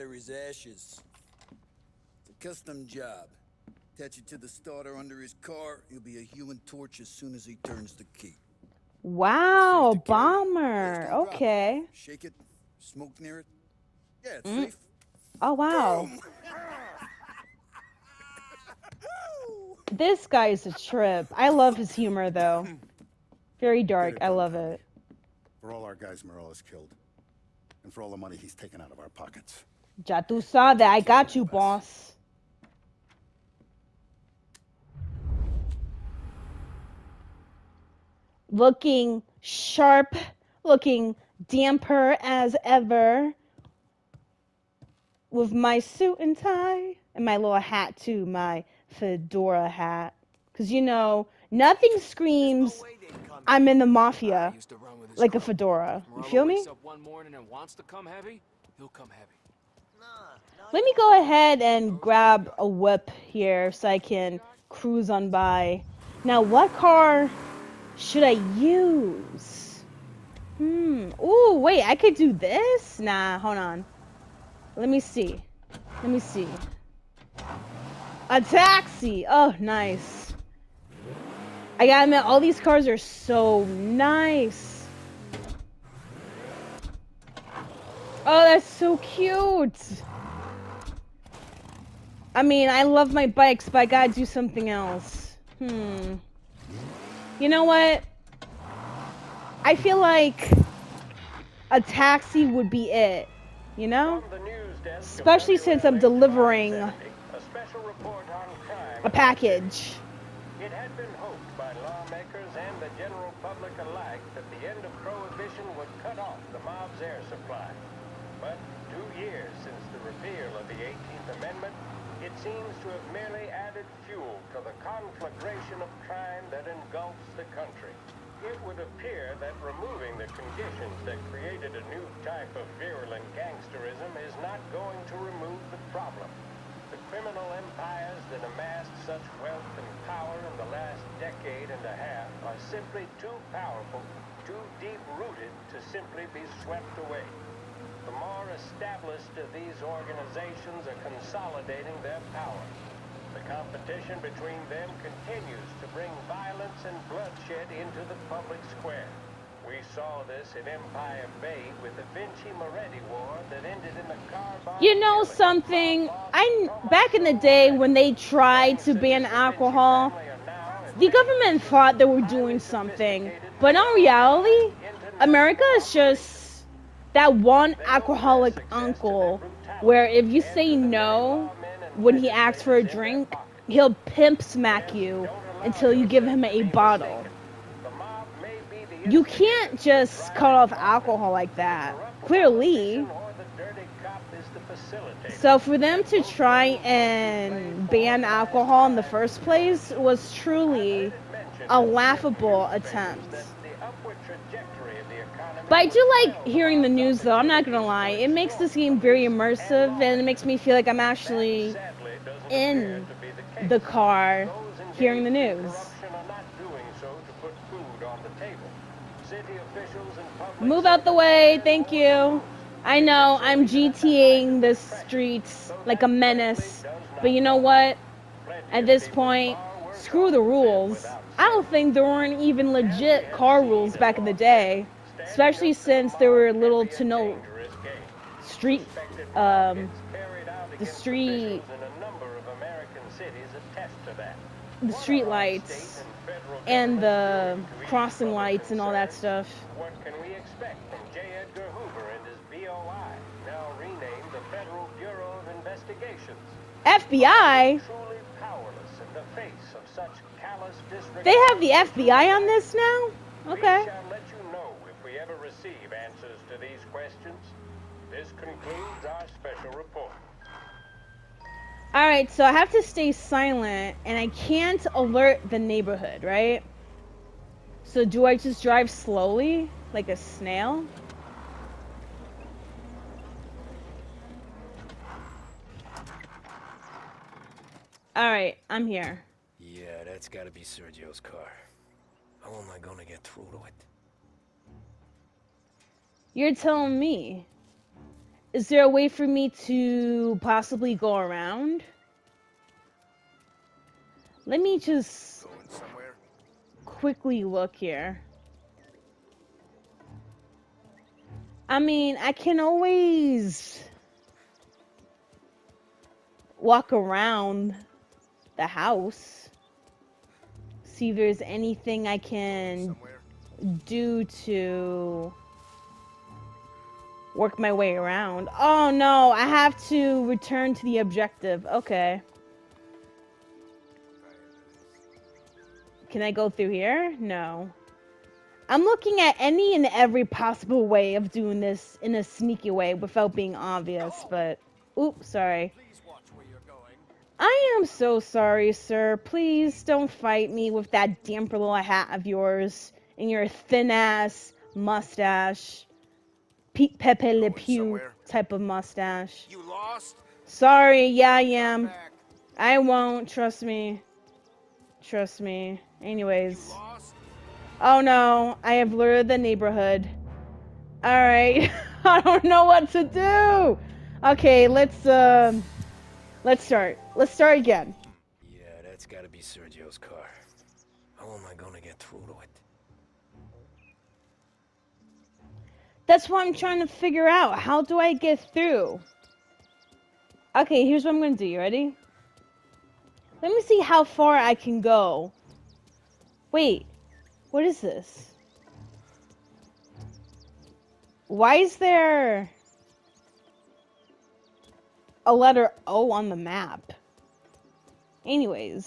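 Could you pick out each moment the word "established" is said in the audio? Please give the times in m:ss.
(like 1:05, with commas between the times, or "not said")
2:28.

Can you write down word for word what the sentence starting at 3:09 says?
You can't just cut off alcohol like that.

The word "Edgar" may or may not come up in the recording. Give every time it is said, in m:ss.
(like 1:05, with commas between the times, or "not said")
4:11.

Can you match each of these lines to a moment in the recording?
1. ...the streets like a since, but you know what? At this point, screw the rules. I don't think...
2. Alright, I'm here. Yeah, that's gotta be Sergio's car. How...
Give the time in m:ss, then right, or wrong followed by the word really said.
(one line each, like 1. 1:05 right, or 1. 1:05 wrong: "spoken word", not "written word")
1. 3:44 wrong: "menace", not "since"
2. 4:48 right.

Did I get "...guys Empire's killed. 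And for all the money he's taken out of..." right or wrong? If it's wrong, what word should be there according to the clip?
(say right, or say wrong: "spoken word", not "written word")
wrong: "Morello", not "Empire".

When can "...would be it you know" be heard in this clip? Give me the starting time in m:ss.
1:42.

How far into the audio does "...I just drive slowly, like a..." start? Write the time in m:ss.
4:38.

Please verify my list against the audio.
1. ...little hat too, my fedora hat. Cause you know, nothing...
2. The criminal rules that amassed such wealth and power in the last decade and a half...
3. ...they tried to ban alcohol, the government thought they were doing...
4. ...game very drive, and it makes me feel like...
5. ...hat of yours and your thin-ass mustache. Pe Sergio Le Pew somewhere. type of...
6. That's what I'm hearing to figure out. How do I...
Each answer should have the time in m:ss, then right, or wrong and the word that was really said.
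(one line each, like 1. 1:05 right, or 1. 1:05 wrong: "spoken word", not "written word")
1. 0:47 right
2. 2:16 wrong: "empires", not "rules"
3. 2:47 right
4. 3:28 wrong: "immersive", not "drive"
5. 5:51 wrong: "Pepe", not "Sergio"
6. 6:26 wrong: "trying", not "hearing".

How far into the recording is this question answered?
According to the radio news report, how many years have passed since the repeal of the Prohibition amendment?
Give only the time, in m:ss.
1:58.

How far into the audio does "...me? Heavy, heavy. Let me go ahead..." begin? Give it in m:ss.
0:56.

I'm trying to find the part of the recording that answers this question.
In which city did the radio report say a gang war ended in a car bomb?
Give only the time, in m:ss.
2:40.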